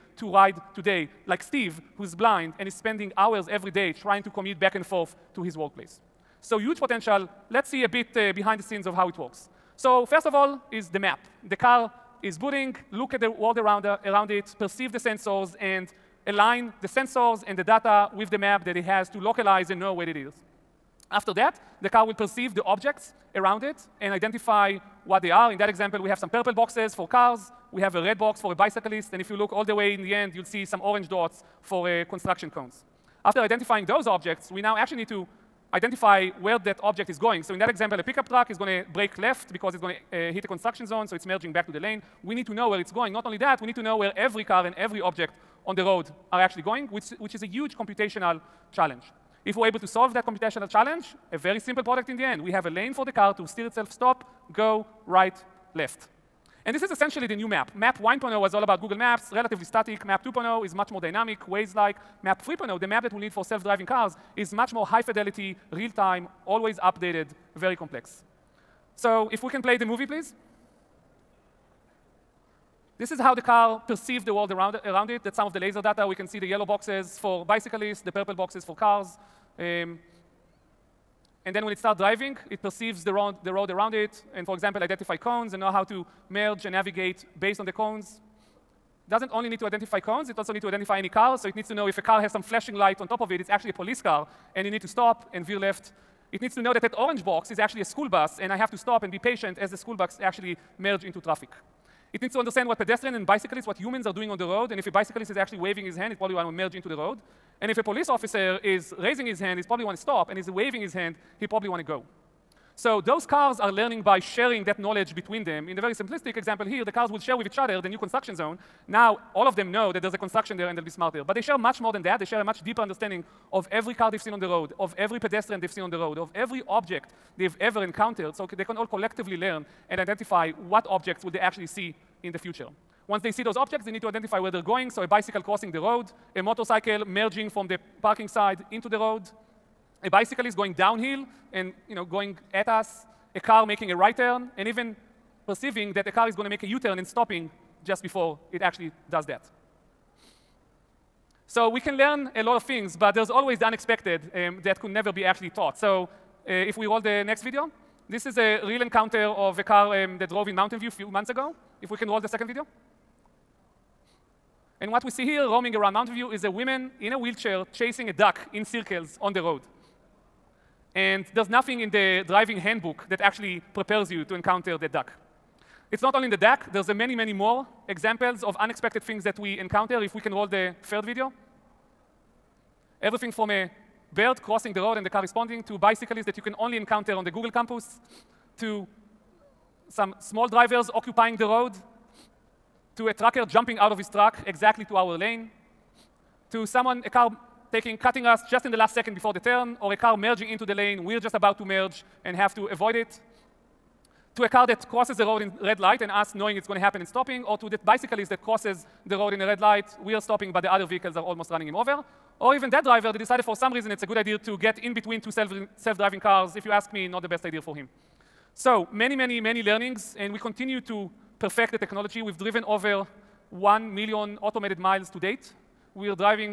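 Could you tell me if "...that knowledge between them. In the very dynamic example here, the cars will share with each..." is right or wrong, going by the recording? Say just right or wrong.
wrong.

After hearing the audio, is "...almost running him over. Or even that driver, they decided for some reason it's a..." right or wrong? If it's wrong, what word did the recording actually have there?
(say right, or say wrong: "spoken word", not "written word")
right.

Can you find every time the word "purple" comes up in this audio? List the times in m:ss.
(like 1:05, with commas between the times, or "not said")
0:26, 1:18.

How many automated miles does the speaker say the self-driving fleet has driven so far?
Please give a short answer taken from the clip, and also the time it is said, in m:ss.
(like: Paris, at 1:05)
Over 1 million, at 3:42.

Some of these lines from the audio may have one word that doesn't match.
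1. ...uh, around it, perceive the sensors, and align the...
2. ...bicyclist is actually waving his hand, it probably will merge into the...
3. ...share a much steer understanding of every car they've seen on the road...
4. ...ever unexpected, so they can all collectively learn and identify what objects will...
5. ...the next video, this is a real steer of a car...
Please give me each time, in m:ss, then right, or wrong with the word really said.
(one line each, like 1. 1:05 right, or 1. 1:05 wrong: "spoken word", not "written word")
1. 0:13 right
2. 1:44 right
3. 2:02 wrong: "deeper", not "steer"
4. 2:07 wrong: "encountered", not "unexpected"
5. 2:37 wrong: "encounter", not "steer".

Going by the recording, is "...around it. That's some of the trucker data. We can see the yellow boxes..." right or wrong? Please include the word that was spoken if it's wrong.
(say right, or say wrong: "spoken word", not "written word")
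wrong: "laser", not "trucker".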